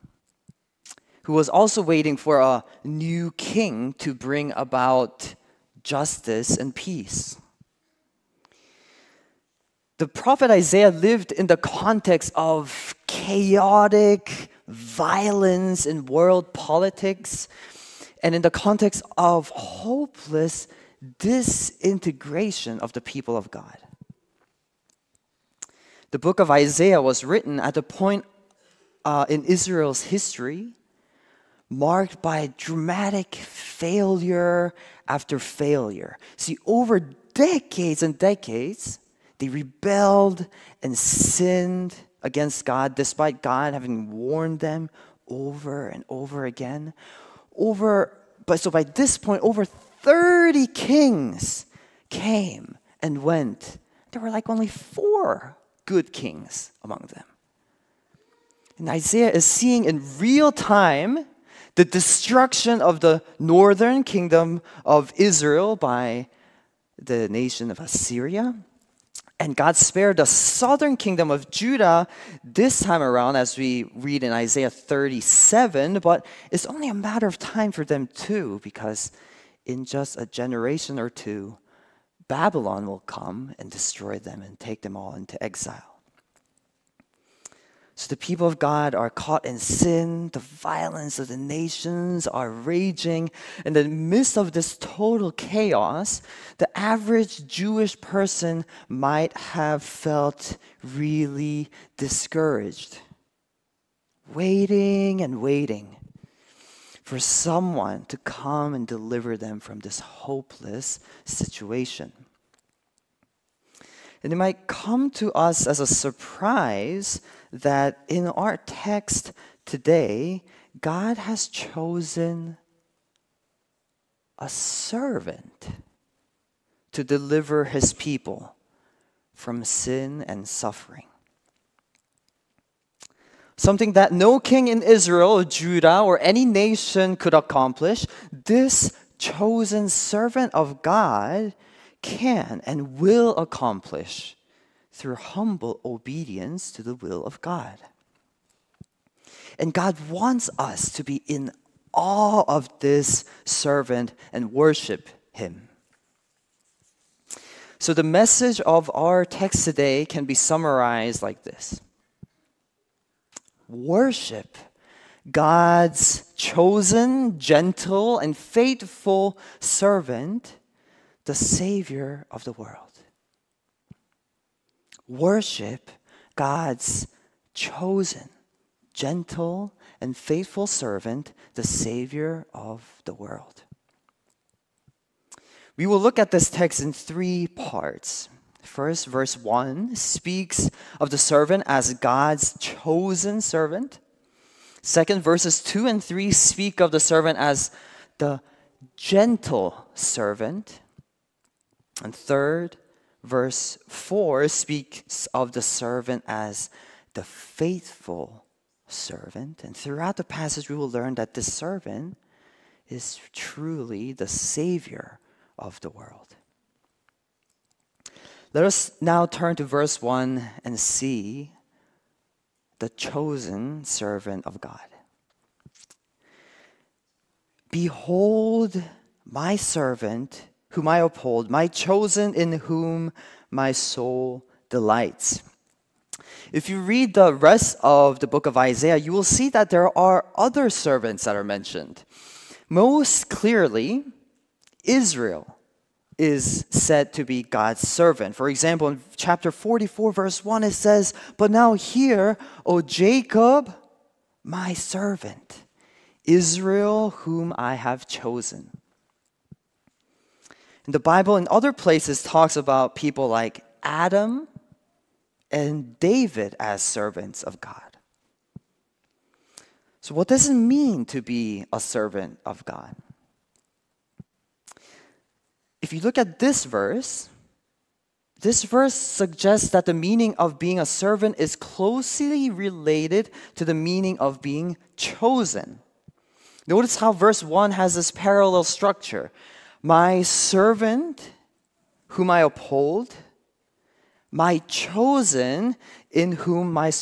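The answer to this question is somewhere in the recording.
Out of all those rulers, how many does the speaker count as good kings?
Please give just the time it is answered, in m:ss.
0:54.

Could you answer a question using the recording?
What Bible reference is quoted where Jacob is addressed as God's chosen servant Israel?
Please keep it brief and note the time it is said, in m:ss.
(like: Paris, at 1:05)
Chapter 44, verse 1, at 4:09.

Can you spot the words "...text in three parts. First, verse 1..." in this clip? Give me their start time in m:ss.
3:06.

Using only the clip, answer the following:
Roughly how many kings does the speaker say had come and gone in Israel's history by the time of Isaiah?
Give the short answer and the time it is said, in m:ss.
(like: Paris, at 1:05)
over 30, at 0:49.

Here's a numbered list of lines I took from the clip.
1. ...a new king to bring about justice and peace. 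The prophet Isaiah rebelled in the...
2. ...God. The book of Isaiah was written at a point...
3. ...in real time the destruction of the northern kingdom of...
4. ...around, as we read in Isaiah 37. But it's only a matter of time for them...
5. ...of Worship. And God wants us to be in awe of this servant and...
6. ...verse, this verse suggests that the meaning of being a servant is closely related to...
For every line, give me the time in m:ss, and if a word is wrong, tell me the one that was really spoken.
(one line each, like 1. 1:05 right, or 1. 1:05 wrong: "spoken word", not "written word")
1. 0:02 wrong: "lived", not "rebelled"
2. 0:23 right
3. 0:59 right
4. 1:12 right
5. 2:27 wrong: "God", not "Worship"
6. 4:36 right.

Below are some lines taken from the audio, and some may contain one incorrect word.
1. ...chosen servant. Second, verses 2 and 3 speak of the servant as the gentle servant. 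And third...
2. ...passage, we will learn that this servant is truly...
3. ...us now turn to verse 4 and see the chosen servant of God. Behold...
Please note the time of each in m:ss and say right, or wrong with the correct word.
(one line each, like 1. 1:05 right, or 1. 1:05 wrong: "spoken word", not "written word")
1. 3:12 right
2. 3:30 right
3. 3:38 wrong: "1", not "4".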